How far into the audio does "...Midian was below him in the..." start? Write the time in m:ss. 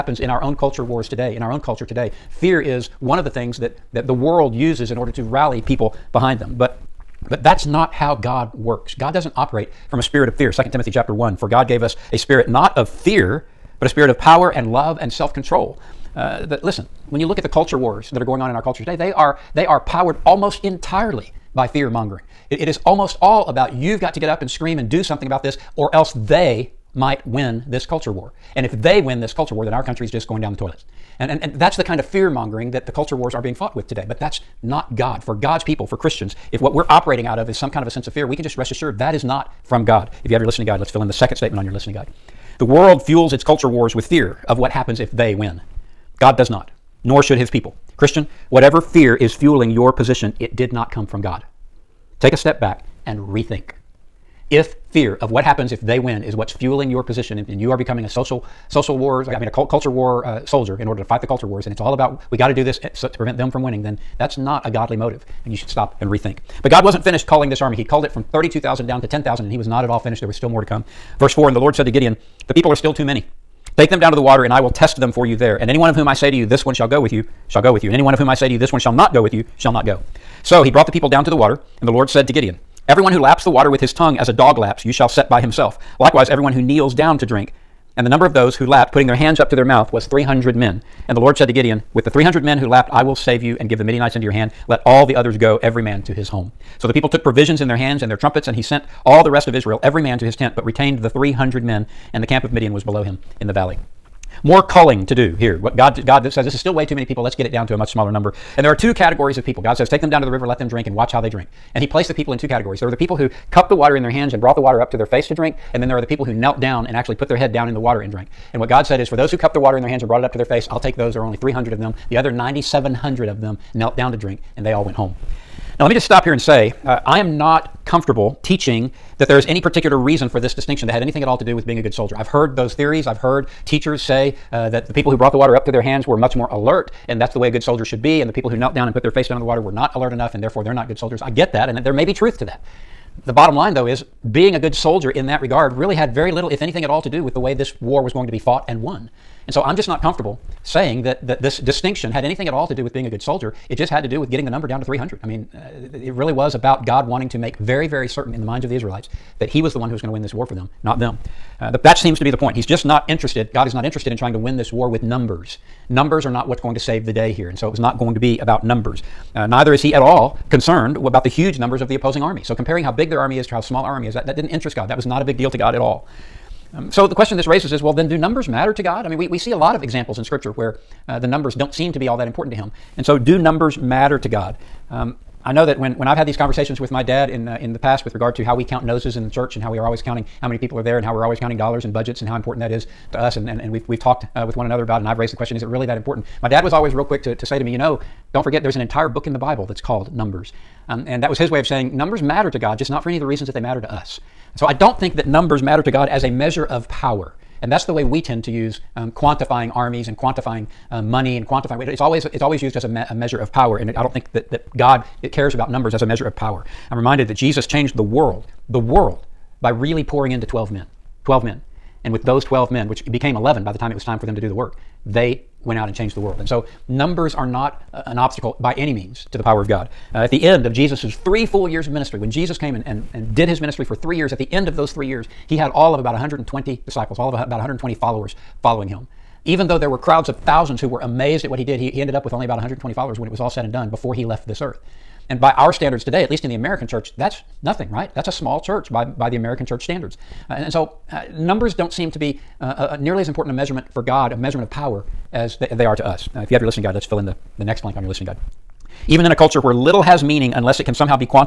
1:42.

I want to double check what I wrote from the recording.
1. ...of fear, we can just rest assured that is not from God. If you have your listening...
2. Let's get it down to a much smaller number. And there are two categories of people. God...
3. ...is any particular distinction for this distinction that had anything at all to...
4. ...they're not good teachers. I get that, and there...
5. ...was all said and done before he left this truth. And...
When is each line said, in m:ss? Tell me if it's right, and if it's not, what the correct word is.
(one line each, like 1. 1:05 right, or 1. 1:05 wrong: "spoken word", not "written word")
1. 0:38 right
2. 1:47 right
3. 2:09 wrong: "reason", not "distinction"
4. 2:20 wrong: "soldiers", not "teachers"
5. 4:03 wrong: "earth", not "truth".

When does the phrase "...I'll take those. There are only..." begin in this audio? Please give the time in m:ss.
2:00.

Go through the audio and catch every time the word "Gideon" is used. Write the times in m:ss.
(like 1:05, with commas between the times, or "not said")
1:11, 1:22, 1:31.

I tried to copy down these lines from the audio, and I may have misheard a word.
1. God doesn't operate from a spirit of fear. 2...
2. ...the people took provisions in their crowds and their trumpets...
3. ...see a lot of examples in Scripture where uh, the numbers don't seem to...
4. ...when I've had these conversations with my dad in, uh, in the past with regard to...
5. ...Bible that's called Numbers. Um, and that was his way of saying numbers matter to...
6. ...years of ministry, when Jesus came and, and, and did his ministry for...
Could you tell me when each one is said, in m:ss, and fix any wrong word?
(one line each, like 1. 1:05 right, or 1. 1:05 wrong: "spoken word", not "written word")
1. 0:08 right
2. 1:36 wrong: "hands", not "crowds"
3. 2:59 right
4. 3:05 right
5. 3:19 right
6. 3:51 right.